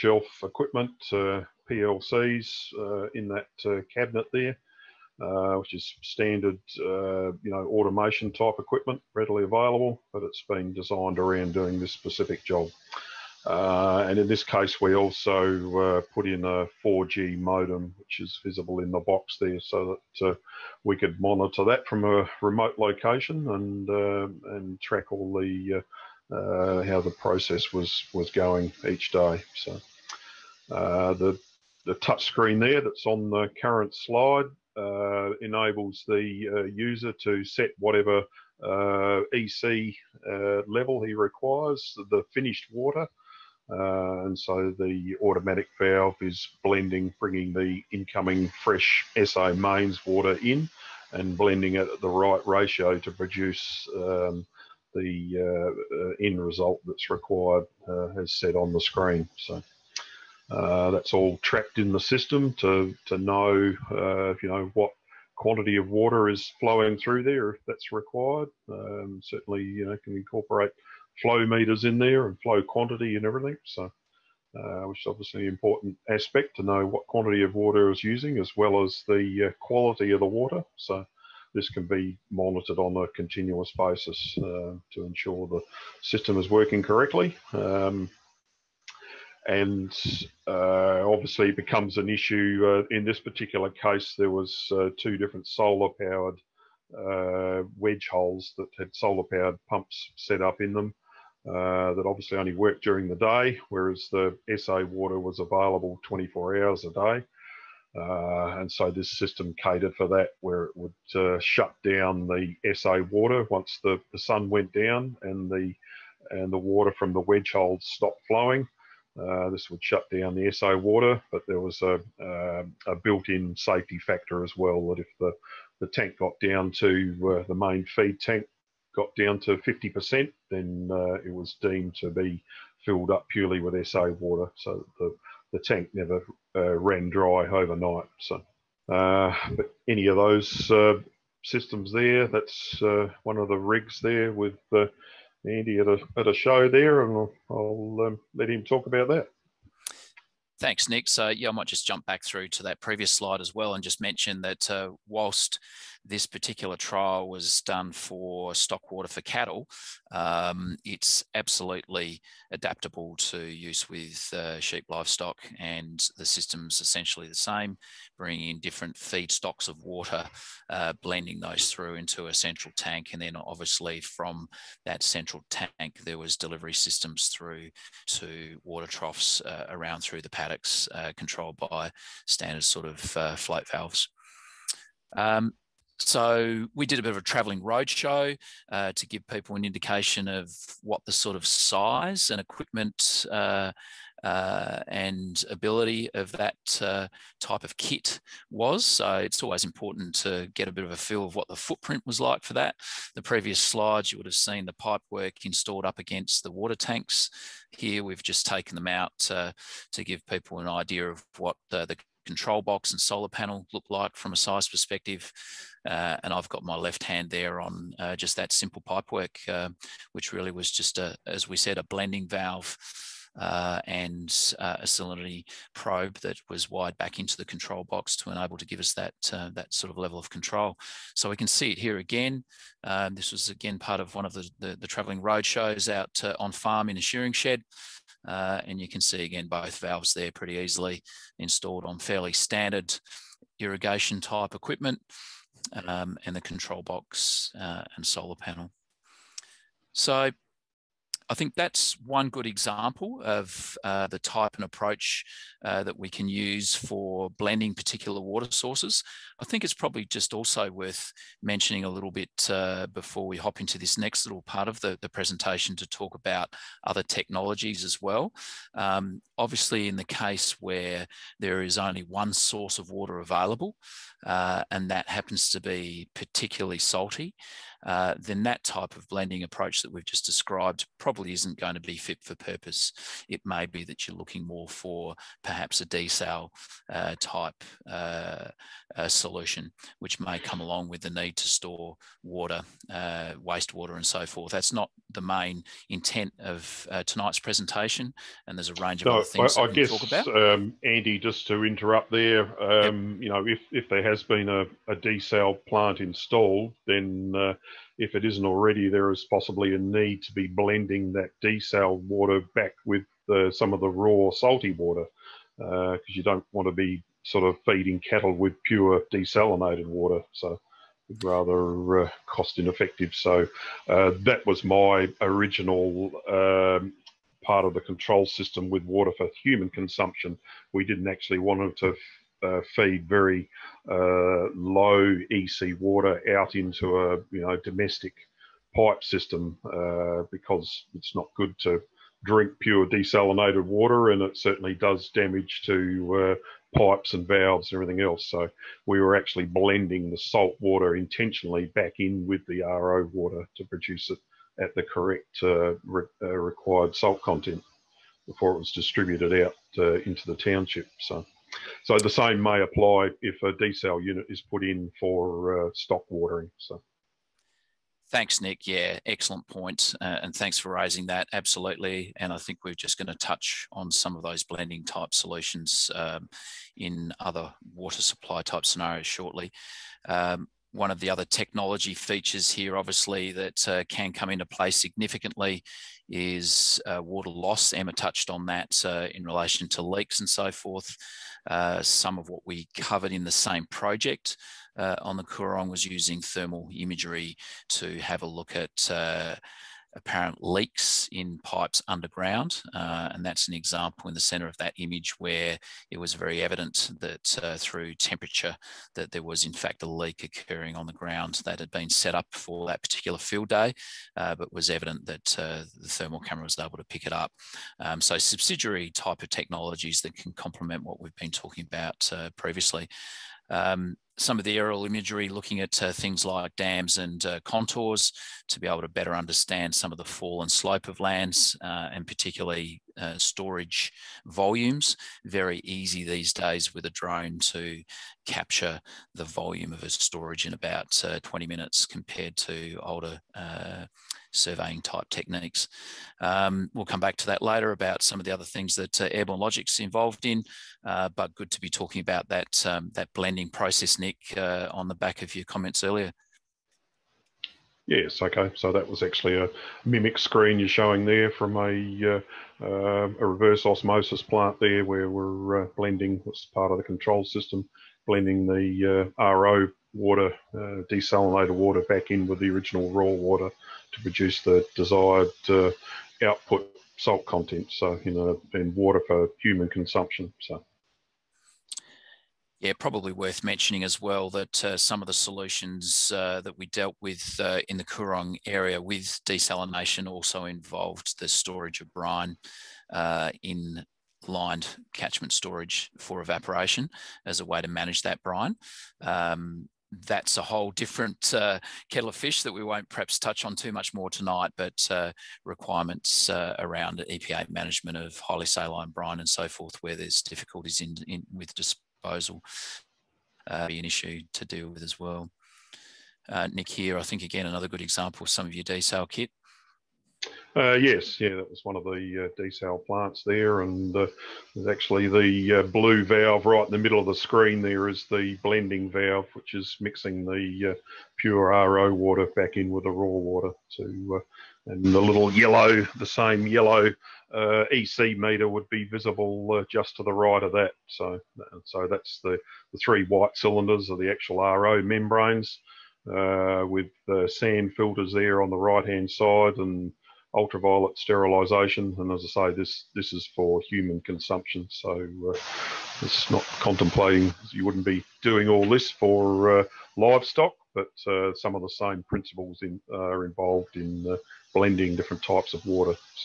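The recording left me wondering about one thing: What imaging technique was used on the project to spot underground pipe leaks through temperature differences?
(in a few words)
Thermal imagery.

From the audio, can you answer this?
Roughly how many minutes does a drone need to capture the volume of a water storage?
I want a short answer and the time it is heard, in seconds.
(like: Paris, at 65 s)
20 minutes, at 441 s.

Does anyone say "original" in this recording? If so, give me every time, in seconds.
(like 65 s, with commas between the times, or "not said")
325 s, 472 s.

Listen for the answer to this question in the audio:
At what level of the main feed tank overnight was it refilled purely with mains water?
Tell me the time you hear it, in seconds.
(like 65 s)
129 s.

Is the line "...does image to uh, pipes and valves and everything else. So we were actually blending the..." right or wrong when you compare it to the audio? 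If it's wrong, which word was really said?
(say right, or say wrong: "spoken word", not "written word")
wrong: "damage", not "image".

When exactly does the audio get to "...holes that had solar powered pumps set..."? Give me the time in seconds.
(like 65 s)
98 s.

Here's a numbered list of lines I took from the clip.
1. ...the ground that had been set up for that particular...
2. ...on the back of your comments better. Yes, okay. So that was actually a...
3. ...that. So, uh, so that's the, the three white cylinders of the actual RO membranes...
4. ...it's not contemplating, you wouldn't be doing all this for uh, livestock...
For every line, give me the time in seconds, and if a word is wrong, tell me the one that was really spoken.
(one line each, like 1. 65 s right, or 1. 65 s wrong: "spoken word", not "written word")
1. 410 s right
2. 454 s wrong: "earlier", not "better"
3. 540 s right
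4. 556 s right.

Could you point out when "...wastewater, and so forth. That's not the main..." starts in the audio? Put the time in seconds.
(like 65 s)
293 s.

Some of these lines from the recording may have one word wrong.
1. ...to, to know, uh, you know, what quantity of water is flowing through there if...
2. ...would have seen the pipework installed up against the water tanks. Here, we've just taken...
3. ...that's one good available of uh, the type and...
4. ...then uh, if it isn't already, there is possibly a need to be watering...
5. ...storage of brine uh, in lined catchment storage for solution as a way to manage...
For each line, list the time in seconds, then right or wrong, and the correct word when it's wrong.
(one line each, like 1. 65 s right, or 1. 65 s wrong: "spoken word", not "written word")
1. 62 s right
2. 204 s right
3. 251 s wrong: "example", not "available"
4. 306 s wrong: "blending", not "watering"
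5. 491 s wrong: "evaporation", not "solution".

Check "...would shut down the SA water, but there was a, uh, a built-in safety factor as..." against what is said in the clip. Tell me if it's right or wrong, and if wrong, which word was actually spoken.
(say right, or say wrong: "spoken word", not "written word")
right.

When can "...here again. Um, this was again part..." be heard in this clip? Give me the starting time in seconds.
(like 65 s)
231 s.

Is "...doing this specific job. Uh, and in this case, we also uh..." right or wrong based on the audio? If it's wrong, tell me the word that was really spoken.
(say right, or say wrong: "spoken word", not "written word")
right.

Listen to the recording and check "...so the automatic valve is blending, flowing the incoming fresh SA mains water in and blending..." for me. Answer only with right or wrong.
wrong.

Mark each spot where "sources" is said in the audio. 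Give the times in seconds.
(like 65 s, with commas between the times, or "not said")
258 s, 272 s.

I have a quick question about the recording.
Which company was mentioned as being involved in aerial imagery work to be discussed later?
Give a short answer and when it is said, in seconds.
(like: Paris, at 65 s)
Airborne Logic, at 449 s.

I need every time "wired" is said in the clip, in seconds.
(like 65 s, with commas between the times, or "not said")
226 s.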